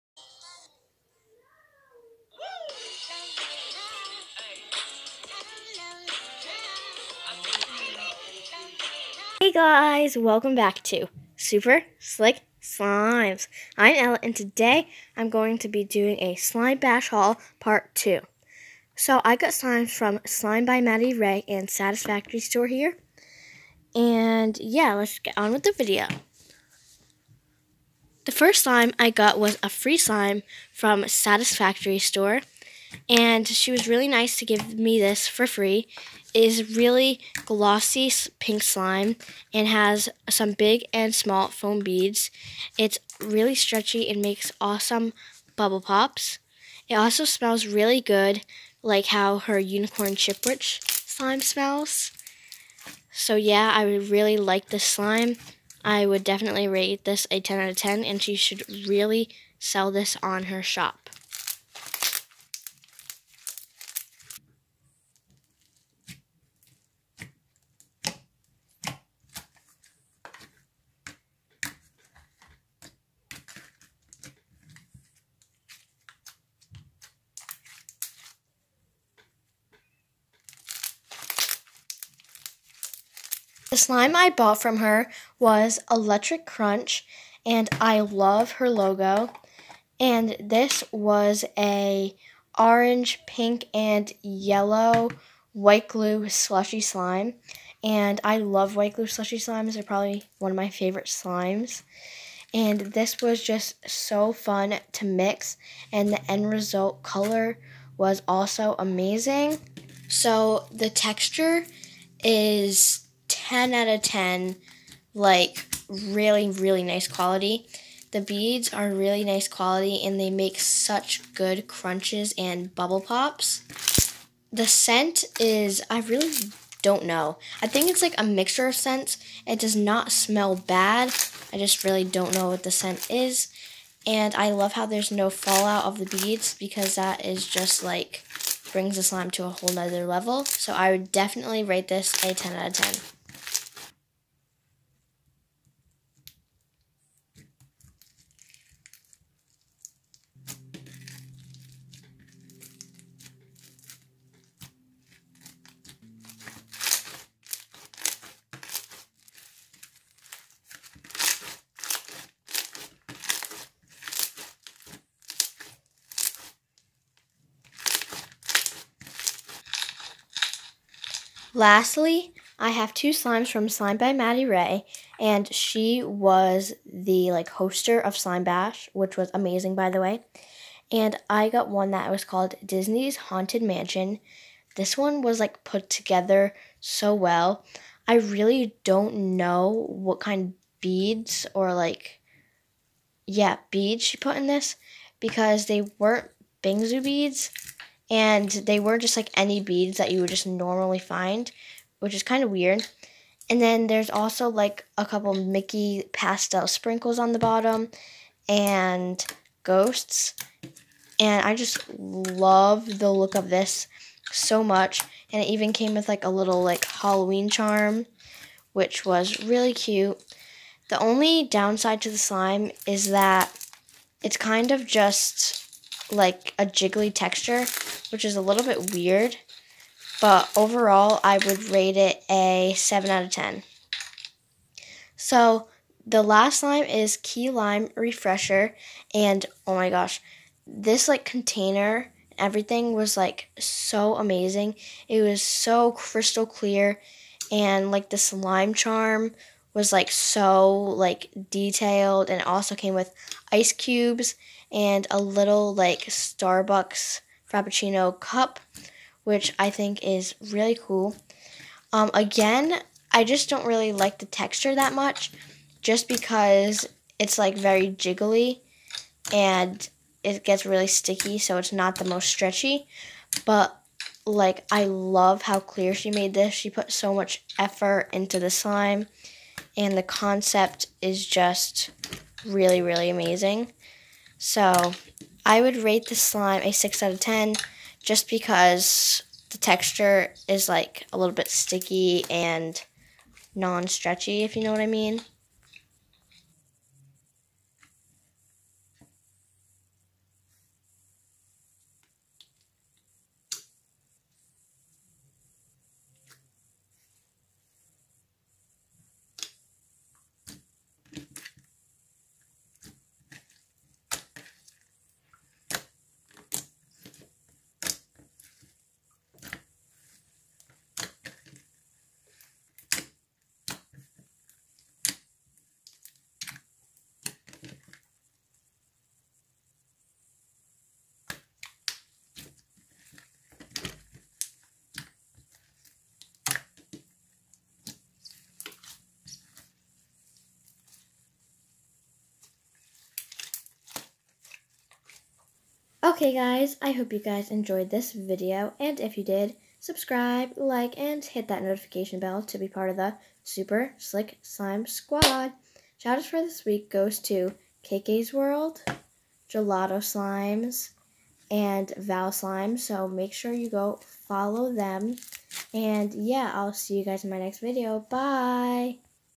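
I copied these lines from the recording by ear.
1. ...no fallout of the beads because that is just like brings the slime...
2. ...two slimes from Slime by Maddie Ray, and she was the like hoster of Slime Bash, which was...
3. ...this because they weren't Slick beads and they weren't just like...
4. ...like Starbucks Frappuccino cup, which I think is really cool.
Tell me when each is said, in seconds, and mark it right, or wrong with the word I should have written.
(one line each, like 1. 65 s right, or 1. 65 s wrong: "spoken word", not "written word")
1. 135 s right
2. 172 s right
3. 194 s wrong: "Bingsu", not "Slick"
4. 255 s right.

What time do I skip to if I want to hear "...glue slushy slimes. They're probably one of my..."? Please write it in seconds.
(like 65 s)
98 s.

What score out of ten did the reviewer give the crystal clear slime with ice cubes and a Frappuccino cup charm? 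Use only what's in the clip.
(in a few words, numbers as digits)
6.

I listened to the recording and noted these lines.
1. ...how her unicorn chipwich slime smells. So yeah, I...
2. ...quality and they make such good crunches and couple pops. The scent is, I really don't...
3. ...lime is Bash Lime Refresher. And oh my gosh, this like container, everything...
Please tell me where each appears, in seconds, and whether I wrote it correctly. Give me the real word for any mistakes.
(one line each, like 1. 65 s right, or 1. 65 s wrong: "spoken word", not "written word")
1. 49 s right
2. 119 s wrong: "bubble", not "couple"
3. 236 s wrong: "Key", not "Bash".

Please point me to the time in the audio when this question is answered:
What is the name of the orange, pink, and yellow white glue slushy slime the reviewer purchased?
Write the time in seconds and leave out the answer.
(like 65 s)
85 s.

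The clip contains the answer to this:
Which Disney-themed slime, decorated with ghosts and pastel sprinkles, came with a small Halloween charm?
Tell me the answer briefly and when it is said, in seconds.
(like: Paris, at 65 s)
Disney's Haunted Mansion, at 182 s.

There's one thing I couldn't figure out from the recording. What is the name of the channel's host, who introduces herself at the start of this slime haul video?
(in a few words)
Ella.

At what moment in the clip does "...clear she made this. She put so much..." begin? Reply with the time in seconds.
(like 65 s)
275 s.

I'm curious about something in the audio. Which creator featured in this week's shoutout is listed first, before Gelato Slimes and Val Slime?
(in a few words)
KK's World.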